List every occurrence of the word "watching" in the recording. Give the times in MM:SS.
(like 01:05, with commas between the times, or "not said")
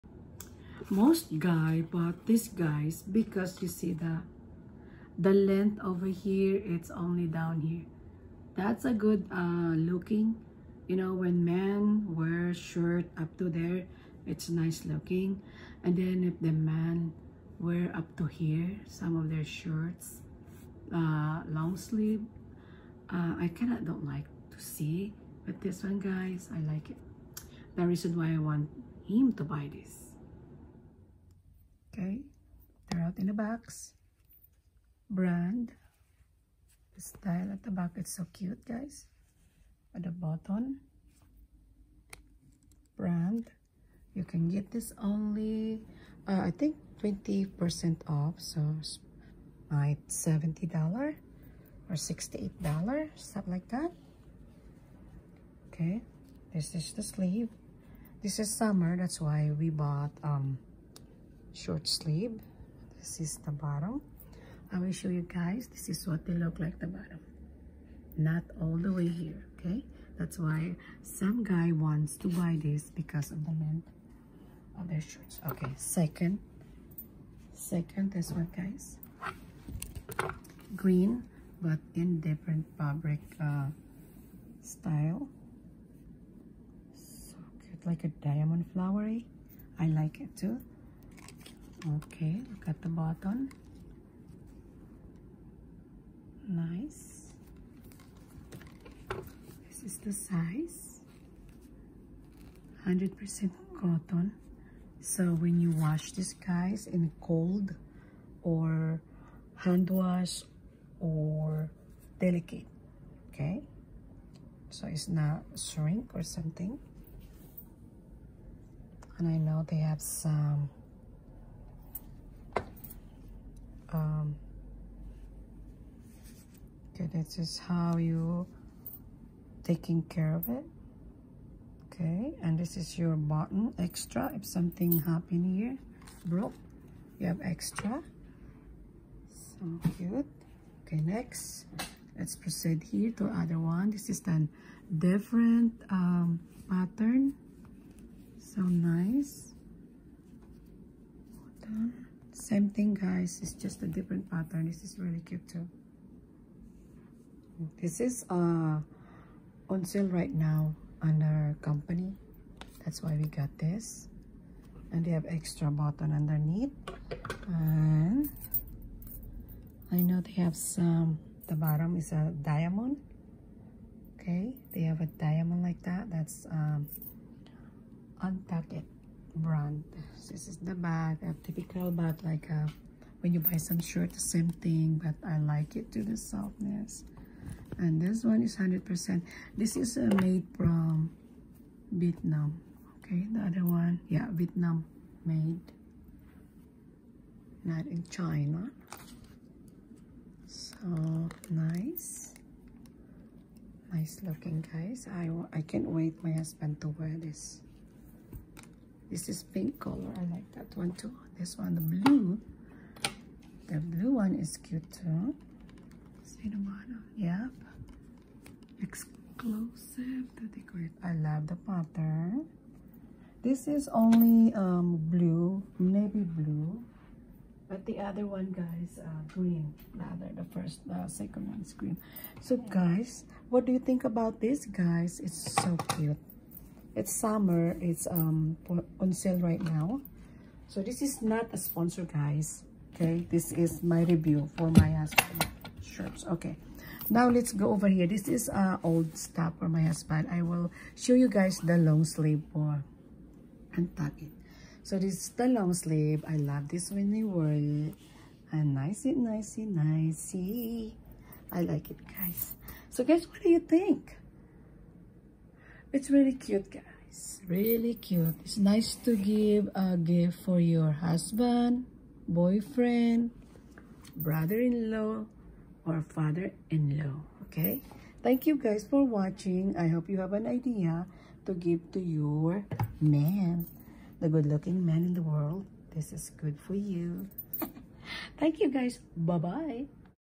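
04:39.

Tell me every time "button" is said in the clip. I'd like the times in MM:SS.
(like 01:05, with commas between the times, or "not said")
02:13, 02:45.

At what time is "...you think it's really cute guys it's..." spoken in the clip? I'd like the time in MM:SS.
04:23.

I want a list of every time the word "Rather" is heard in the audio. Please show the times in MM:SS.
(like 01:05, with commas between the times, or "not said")
03:49.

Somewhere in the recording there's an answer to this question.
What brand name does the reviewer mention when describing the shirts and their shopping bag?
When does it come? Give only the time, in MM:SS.
02:58.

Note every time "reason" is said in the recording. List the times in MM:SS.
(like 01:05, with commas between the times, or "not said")
00:27.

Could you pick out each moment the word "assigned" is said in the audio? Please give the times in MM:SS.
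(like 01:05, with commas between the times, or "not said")
not said.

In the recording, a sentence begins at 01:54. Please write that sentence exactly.
So it's not shrink or something.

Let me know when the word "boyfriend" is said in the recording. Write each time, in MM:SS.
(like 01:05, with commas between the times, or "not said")
04:32.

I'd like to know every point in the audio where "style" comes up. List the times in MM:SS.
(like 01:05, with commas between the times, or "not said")
00:37, 01:24.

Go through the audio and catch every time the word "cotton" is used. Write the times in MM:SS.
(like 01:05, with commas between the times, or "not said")
01:43.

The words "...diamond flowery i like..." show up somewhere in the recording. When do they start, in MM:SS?
01:28.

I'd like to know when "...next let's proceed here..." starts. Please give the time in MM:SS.
02:21.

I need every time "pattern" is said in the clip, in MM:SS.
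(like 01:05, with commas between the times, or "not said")
02:26, 02:34, 03:41.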